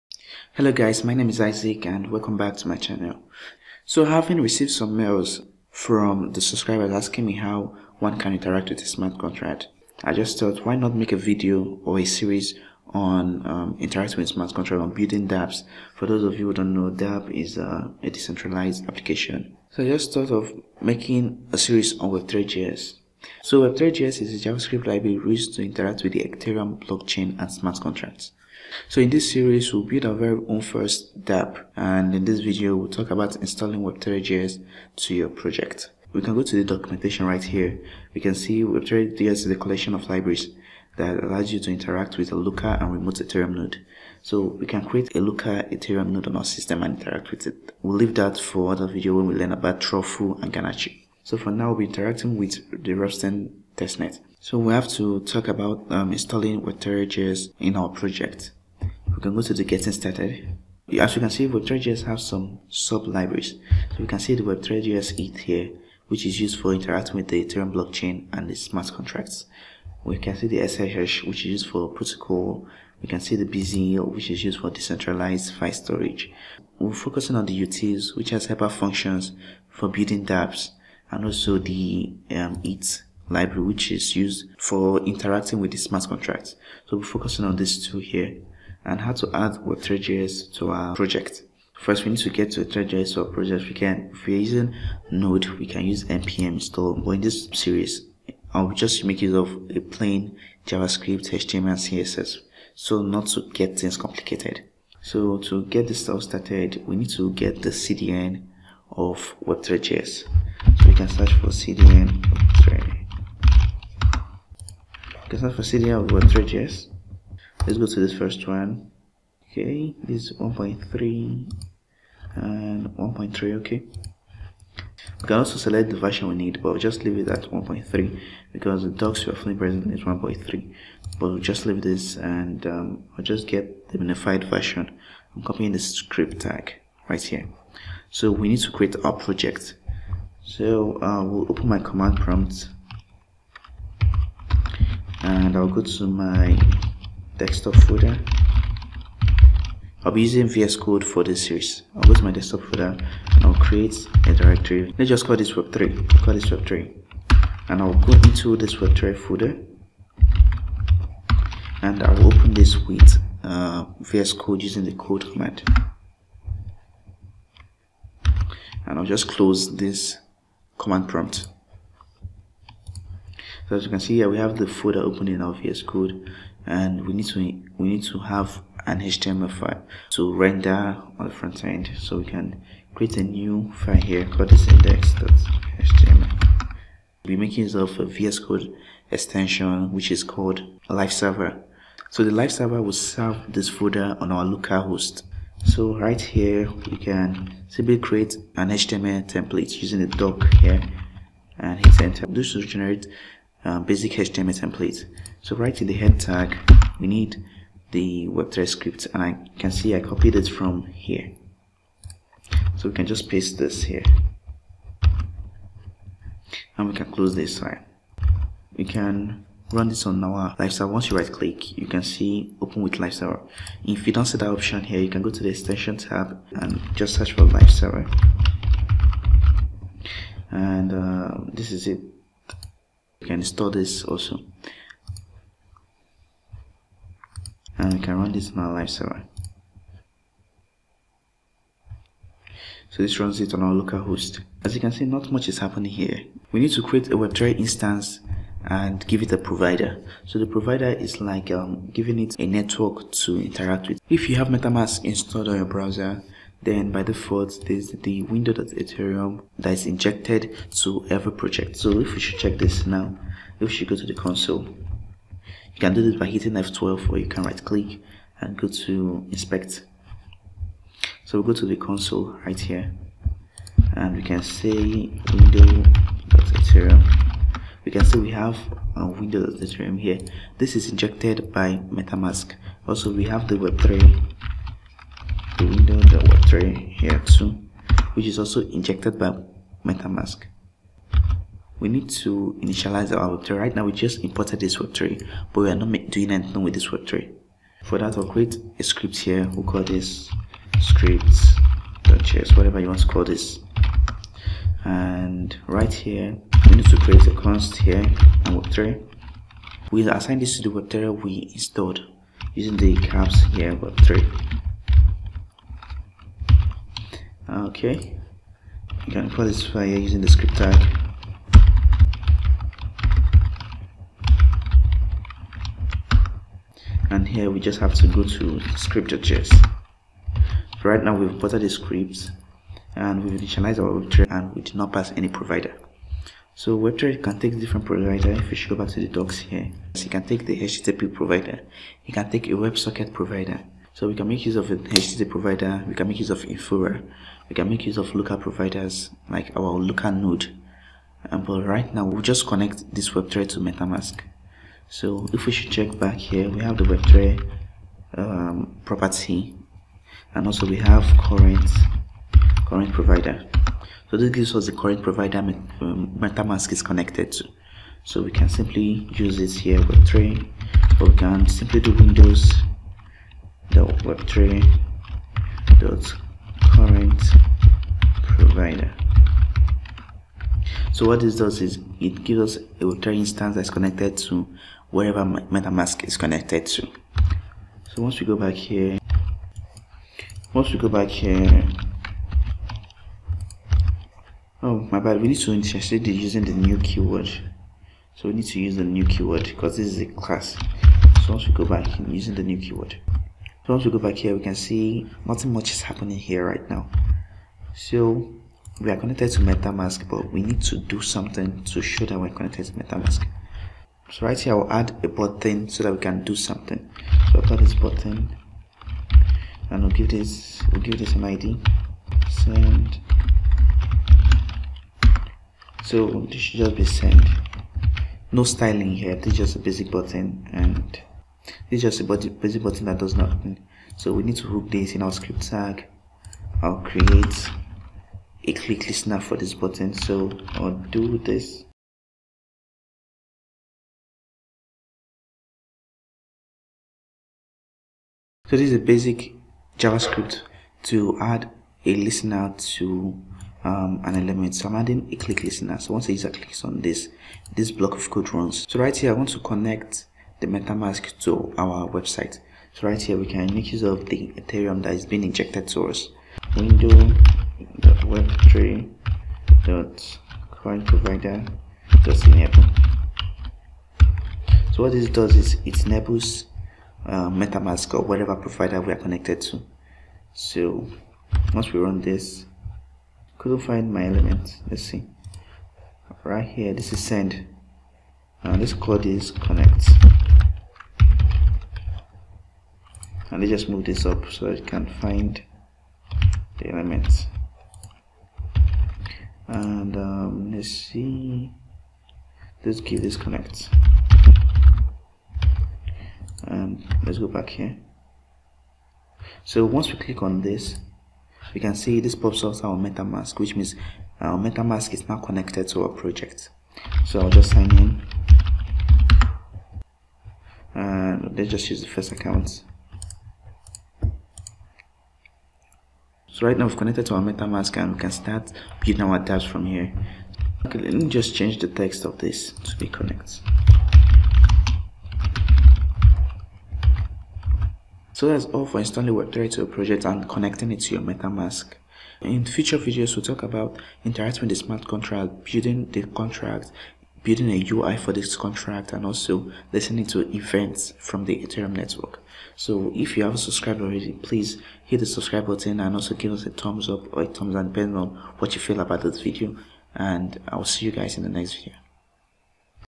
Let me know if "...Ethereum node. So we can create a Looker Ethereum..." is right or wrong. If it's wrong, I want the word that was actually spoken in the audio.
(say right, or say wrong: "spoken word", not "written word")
right.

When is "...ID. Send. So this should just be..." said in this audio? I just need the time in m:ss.
7:01.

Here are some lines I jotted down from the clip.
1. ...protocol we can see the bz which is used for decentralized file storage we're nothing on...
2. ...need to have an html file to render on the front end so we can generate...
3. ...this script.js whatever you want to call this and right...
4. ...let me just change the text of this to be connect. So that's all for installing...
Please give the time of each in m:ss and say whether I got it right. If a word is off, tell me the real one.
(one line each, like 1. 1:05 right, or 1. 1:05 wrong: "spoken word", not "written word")
1. 1:11 wrong: "focusing", not "nothing"
2. 2:57 wrong: "create", not "generate"
3. 4:59 right
4. 8:50 right.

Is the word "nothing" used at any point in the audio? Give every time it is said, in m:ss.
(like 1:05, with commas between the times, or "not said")
6:45.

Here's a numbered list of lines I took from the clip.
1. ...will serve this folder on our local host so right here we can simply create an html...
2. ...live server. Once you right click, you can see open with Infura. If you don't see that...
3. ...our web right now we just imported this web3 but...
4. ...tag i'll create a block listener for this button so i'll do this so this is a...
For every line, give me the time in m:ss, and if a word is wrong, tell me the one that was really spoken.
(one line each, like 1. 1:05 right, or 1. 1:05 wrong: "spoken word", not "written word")
1. 3:12 right
2. 3:40 wrong: "Server", not "Infura"
3. 4:53 right
4. 7:15 wrong: "click", not "block".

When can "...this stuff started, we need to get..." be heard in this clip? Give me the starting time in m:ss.
1:45.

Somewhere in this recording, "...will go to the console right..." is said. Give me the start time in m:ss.
4:31.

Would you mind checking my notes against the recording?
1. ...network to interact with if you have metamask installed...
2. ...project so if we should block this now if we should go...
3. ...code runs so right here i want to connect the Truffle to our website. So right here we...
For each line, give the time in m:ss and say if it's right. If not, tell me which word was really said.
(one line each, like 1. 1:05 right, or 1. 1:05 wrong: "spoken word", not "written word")
1. 4:12 right
2. 4:21 wrong: "check", not "block"
3. 7:38 wrong: "MetaMask", not "Truffle".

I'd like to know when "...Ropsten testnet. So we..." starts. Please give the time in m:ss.
0:52.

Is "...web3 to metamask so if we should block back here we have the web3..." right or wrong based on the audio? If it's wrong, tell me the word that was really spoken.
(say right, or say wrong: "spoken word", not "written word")
wrong: "check", not "block".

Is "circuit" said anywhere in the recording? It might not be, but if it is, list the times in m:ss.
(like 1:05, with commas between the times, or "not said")
not said.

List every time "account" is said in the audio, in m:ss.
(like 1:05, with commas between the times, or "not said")
8:42.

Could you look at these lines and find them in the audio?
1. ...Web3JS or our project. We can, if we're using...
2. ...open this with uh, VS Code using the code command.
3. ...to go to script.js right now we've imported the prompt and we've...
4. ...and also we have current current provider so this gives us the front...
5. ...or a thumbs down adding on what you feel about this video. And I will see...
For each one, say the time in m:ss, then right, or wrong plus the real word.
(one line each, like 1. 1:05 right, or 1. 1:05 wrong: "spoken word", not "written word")
1. 1:32 right
2. 2:42 right
3. 5:27 wrong: "script", not "prompt"
4. 6:00 wrong: "current", not "front"
5. 9:17 wrong: "depending", not "adding".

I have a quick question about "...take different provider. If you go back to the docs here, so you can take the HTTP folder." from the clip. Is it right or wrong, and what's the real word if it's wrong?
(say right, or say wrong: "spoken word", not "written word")
wrong: "provider", not "folder".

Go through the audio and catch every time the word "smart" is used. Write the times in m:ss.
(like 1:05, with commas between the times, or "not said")
0:08, 0:14, 0:27, 1:08, 1:25, 9:04.